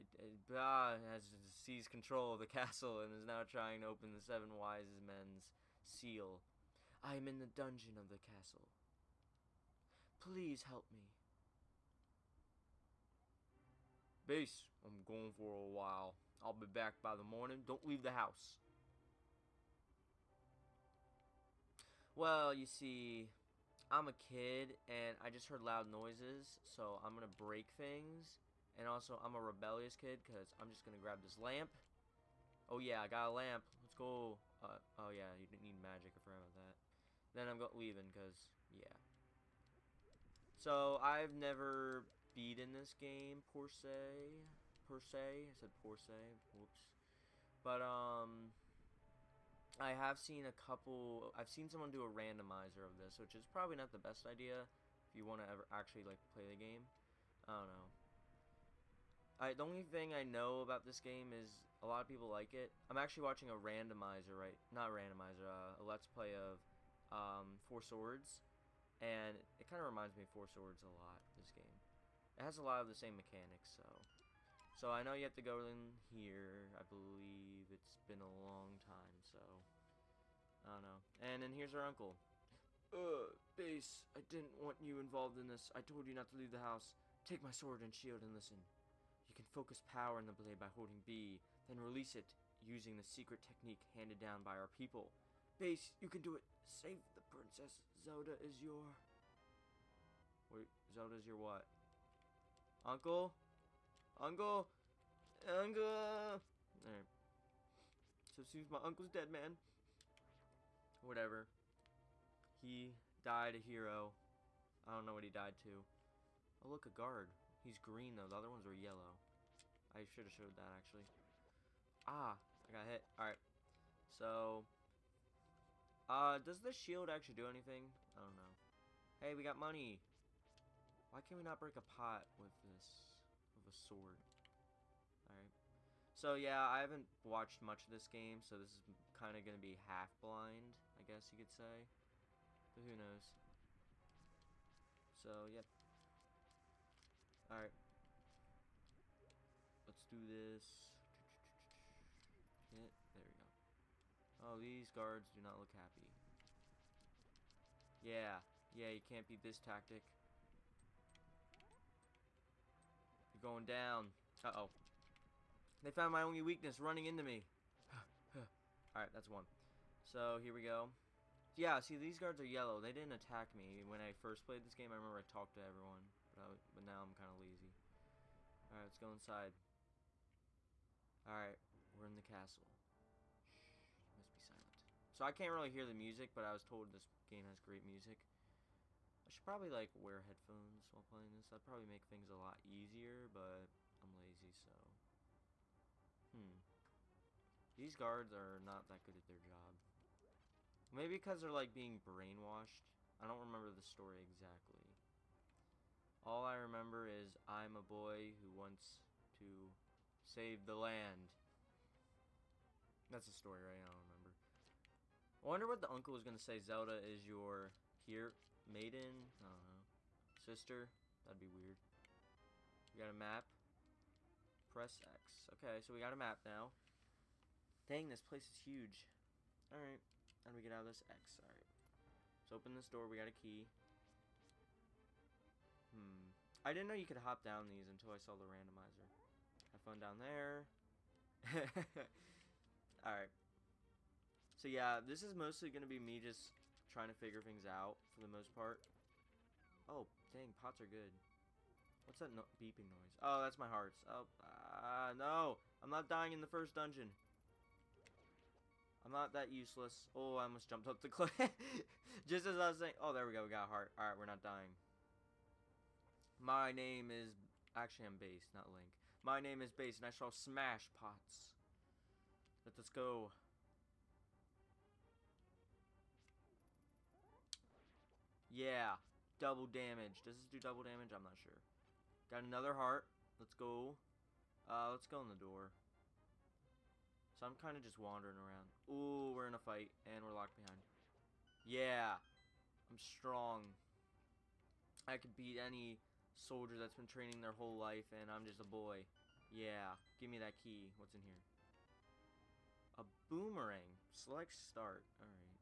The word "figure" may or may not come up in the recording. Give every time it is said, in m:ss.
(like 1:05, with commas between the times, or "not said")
4:07.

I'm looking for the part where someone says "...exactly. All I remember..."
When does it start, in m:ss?
3:24.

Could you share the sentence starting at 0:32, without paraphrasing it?
Oh yeah, I got a lamp.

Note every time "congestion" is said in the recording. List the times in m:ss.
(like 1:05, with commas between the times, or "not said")
not said.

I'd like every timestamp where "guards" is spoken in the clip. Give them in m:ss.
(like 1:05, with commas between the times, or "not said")
1:56, 2:34, 2:52, 3:17.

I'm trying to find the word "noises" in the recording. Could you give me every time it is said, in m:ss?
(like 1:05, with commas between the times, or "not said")
0:25, 4:12.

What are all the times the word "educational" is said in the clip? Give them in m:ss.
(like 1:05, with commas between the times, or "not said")
not said.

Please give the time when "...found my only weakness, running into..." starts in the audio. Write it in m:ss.
2:45.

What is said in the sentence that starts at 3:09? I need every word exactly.
I should probably like wear headphones while playing this.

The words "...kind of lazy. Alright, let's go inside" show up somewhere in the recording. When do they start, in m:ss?
2:57.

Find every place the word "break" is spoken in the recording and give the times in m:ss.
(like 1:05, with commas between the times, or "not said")
0:27, 2:11.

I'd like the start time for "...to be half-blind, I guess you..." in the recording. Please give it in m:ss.
2:19.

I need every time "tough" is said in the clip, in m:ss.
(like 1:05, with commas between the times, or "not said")
not said.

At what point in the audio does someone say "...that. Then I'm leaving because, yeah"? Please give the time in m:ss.
0:36.